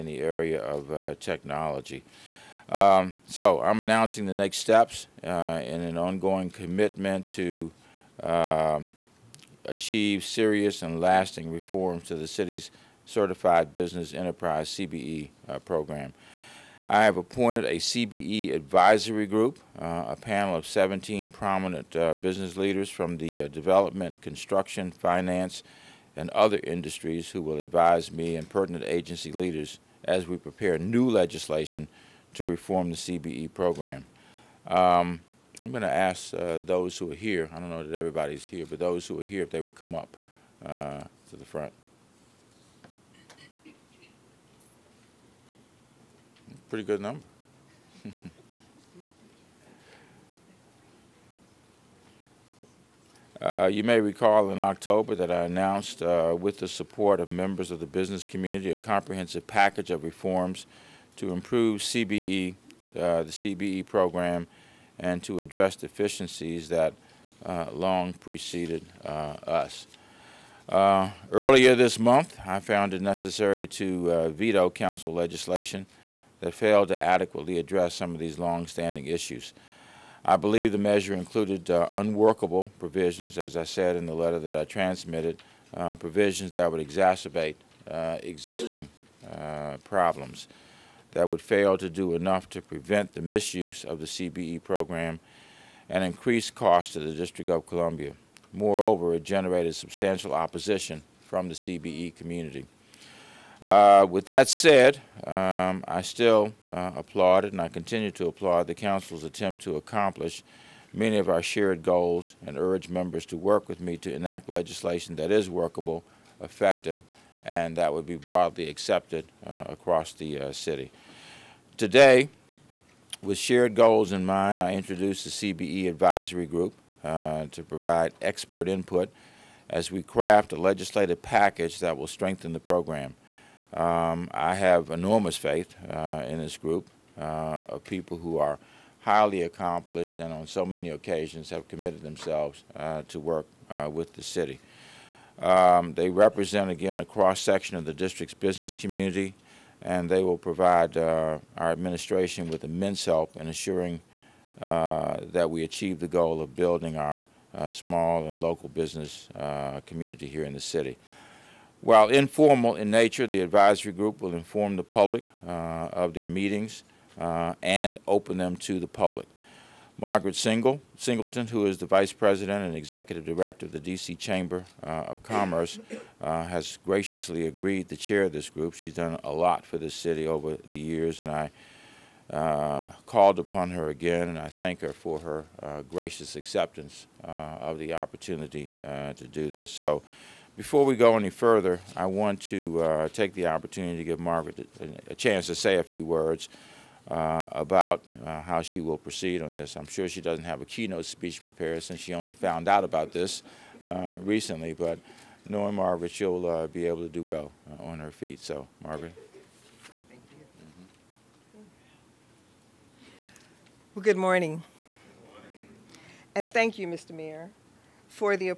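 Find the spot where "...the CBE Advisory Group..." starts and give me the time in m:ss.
2:05.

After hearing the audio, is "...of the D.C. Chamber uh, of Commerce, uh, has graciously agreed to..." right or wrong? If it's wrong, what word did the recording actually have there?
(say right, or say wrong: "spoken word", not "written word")
right.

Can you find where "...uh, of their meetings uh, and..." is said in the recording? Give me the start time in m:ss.
2:45.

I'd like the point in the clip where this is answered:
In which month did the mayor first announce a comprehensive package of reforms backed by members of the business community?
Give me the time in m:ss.
0:54.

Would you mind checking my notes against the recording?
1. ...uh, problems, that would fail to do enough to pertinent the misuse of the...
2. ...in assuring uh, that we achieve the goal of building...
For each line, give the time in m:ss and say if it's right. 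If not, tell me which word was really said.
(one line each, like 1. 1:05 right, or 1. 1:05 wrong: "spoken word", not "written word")
1. 1:29 wrong: "prevent", not "pertinent"
2. 2:33 right.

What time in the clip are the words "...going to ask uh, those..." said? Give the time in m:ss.
0:35.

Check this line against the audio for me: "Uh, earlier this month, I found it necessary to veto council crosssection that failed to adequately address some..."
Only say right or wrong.
wrong.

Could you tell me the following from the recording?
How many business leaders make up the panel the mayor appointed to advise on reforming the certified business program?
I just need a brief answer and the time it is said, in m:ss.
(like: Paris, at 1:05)
17, at 0:20.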